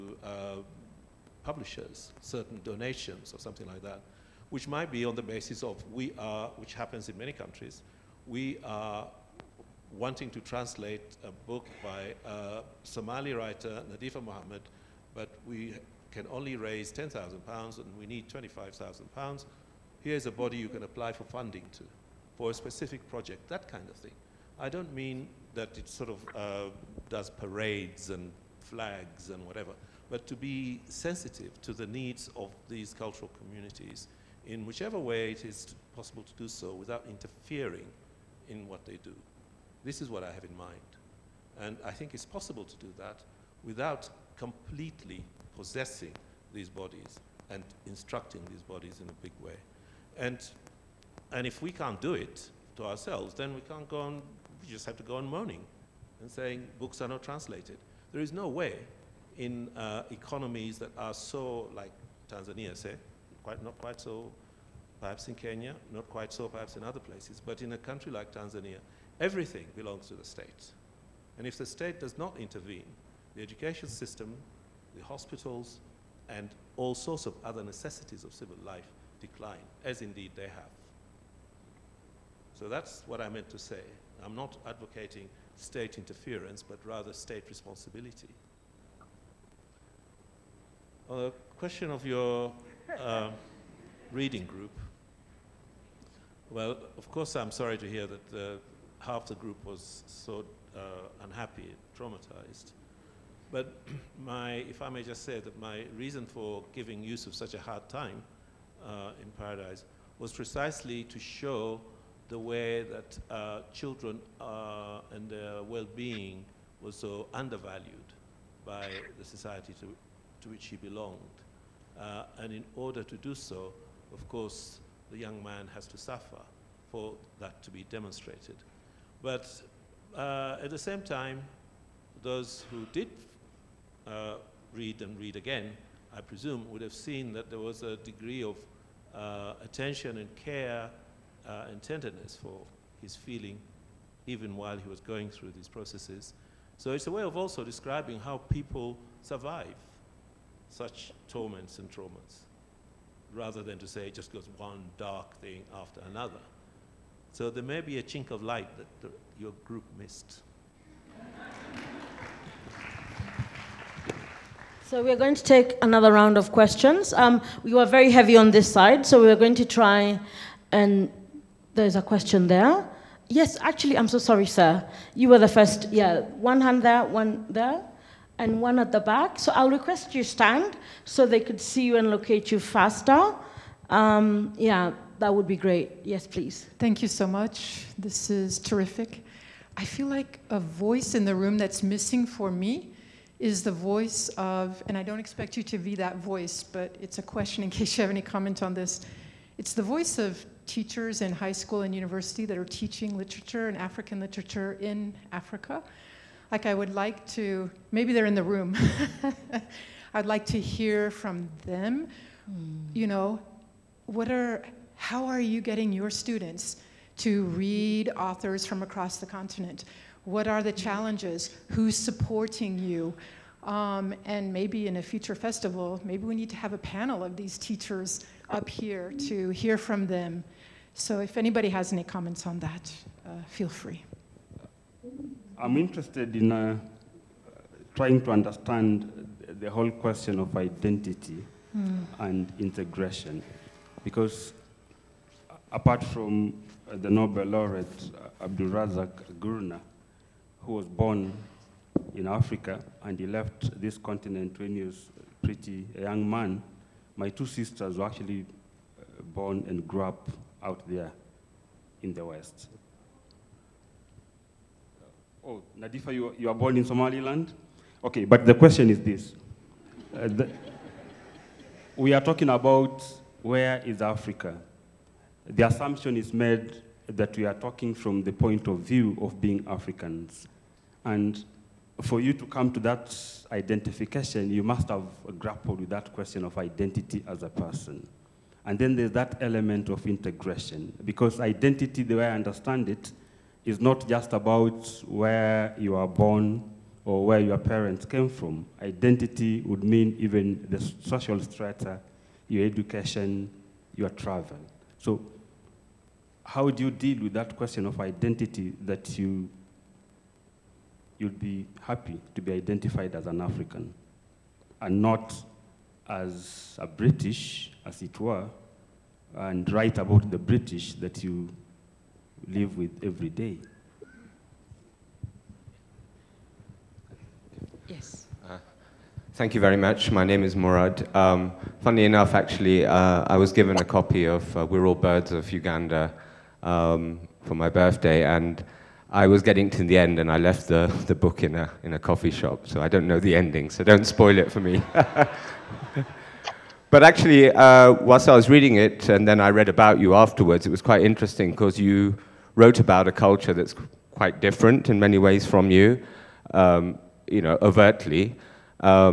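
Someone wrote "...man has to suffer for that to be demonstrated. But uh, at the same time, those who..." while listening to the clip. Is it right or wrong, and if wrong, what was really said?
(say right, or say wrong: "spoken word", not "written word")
right.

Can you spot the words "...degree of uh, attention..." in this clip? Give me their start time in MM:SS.
02:17.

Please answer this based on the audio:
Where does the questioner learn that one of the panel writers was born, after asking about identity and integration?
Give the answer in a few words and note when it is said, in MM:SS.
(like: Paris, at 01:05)
Somaliland, at 04:26.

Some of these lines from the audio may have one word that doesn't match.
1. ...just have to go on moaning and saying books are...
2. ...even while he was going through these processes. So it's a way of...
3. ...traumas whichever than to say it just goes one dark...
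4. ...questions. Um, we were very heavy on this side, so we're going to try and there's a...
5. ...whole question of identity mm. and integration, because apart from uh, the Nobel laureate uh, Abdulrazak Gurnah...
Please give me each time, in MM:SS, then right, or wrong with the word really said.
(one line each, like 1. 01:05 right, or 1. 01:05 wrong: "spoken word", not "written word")
1. 00:54 right
2. 02:24 right
3. 02:31 wrong: "rather", not "whichever"
4. 02:46 right
5. 03:59 right.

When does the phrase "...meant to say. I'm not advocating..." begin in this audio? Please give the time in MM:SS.
01:23.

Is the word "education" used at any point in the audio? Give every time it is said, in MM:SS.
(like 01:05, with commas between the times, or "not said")
01:13, 05:02.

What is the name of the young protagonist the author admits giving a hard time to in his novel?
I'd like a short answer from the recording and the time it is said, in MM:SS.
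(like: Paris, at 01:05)
Yusuf, at 01:47.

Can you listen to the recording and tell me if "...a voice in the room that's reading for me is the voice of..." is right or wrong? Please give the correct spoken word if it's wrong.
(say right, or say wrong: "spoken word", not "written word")
wrong: "missing", not "reading".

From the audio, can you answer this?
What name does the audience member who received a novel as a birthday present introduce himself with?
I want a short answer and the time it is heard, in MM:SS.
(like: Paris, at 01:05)
Murad, at 05:30.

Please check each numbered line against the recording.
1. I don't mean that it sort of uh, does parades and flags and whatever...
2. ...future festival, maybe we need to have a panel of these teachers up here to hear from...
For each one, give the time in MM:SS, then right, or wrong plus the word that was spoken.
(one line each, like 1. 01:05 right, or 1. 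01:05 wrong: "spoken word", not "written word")
1. 00:24 right
2. 03:45 right.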